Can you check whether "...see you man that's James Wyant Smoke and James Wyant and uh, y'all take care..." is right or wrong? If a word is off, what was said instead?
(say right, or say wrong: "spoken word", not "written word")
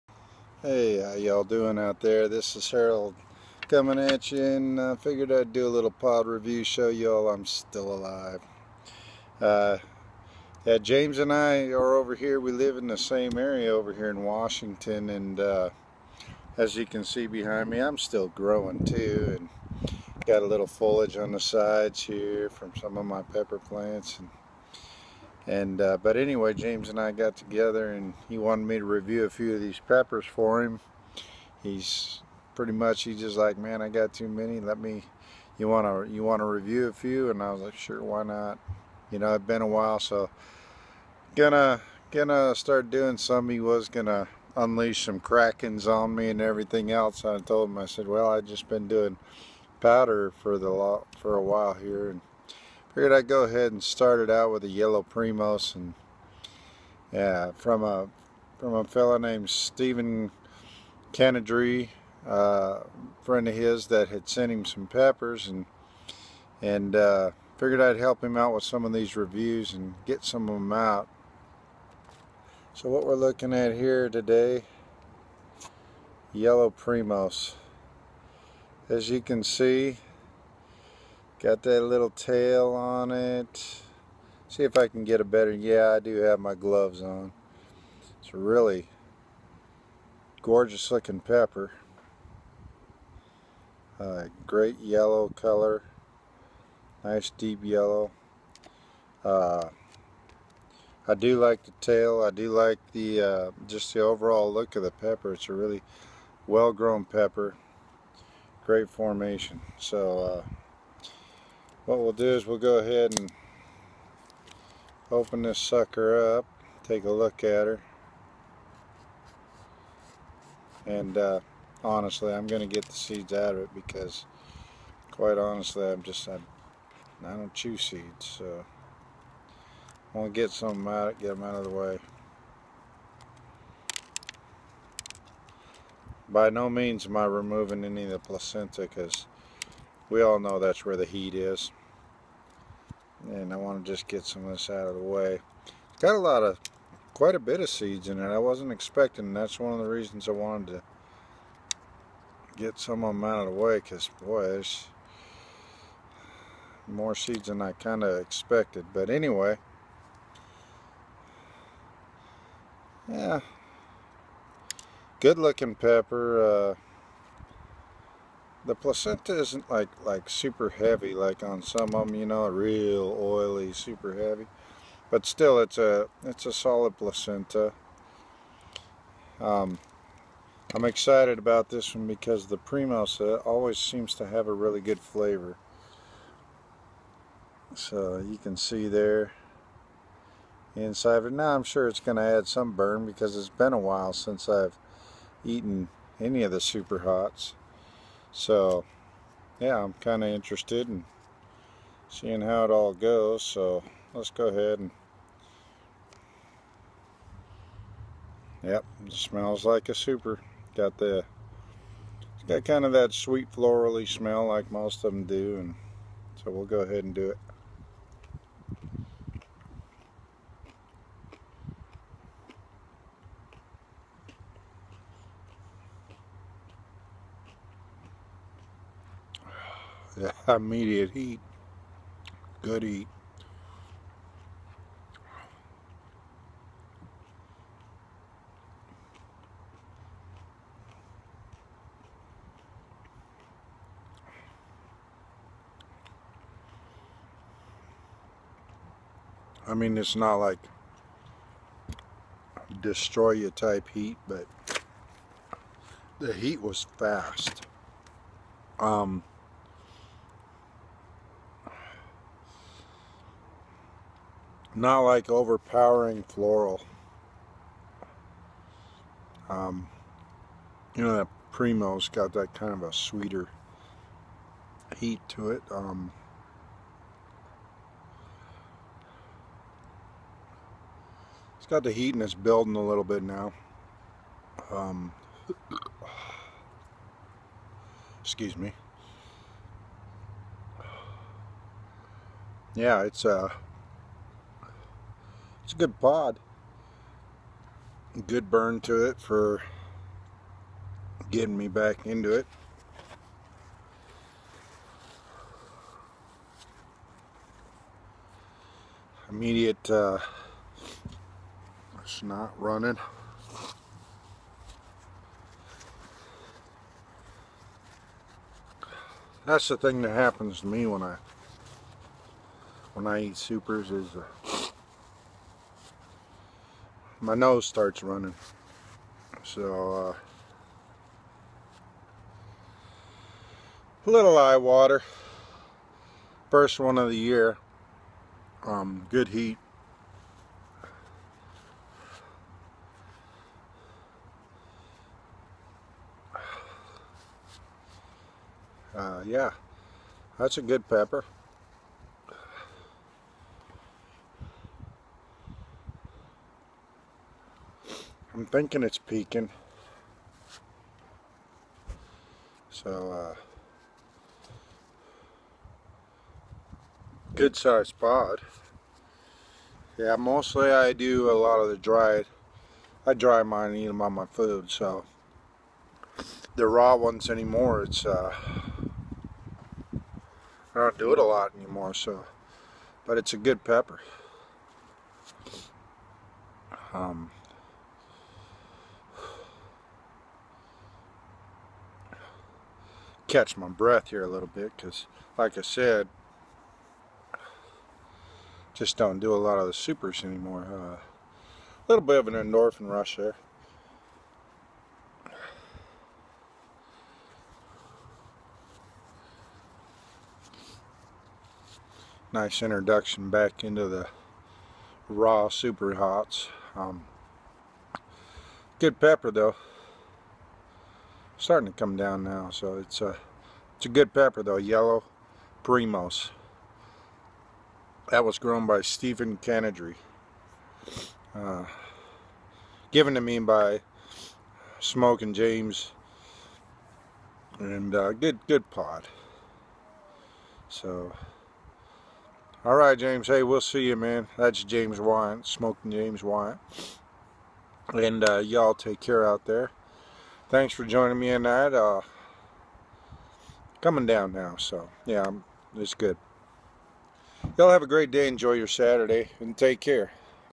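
right.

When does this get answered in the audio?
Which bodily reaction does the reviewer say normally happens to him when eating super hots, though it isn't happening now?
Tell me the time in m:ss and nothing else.
5:27.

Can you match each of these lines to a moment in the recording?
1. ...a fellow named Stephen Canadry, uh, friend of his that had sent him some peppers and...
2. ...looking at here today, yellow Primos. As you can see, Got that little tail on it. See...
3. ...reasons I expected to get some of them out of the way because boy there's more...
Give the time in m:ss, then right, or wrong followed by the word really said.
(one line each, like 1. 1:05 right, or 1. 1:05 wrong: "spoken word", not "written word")
1. 0:58 right
2. 1:13 right
3. 2:29 wrong: "wanted", not "expected".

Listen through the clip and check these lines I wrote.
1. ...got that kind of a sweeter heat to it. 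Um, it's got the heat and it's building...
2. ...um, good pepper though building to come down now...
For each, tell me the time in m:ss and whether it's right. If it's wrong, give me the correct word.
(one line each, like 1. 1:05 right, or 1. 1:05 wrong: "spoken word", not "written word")
1. 4:32 right
2. 6:56 wrong: "starting", not "building".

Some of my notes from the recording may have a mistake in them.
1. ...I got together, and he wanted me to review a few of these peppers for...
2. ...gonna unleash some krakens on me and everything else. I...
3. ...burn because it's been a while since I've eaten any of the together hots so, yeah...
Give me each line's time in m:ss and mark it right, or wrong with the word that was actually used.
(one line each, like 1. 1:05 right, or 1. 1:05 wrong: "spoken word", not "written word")
1. 0:26 right
2. 0:43 right
3. 3:12 wrong: "super", not "together".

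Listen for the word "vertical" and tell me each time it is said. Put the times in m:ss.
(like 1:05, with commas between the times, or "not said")
not said.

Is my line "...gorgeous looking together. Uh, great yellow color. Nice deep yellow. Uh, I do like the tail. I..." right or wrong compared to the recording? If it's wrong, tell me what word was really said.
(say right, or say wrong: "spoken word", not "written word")
wrong: "pepper", not "together".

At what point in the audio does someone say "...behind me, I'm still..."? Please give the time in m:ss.
0:17.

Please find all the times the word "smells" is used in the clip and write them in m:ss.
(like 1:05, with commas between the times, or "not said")
3:29, 3:34.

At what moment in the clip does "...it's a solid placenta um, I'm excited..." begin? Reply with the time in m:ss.
2:56.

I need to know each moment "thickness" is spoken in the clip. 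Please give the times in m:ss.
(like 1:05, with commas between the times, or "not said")
not said.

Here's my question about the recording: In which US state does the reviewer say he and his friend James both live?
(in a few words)
Washington.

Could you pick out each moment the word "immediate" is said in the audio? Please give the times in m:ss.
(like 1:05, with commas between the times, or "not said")
3:50, 5:09.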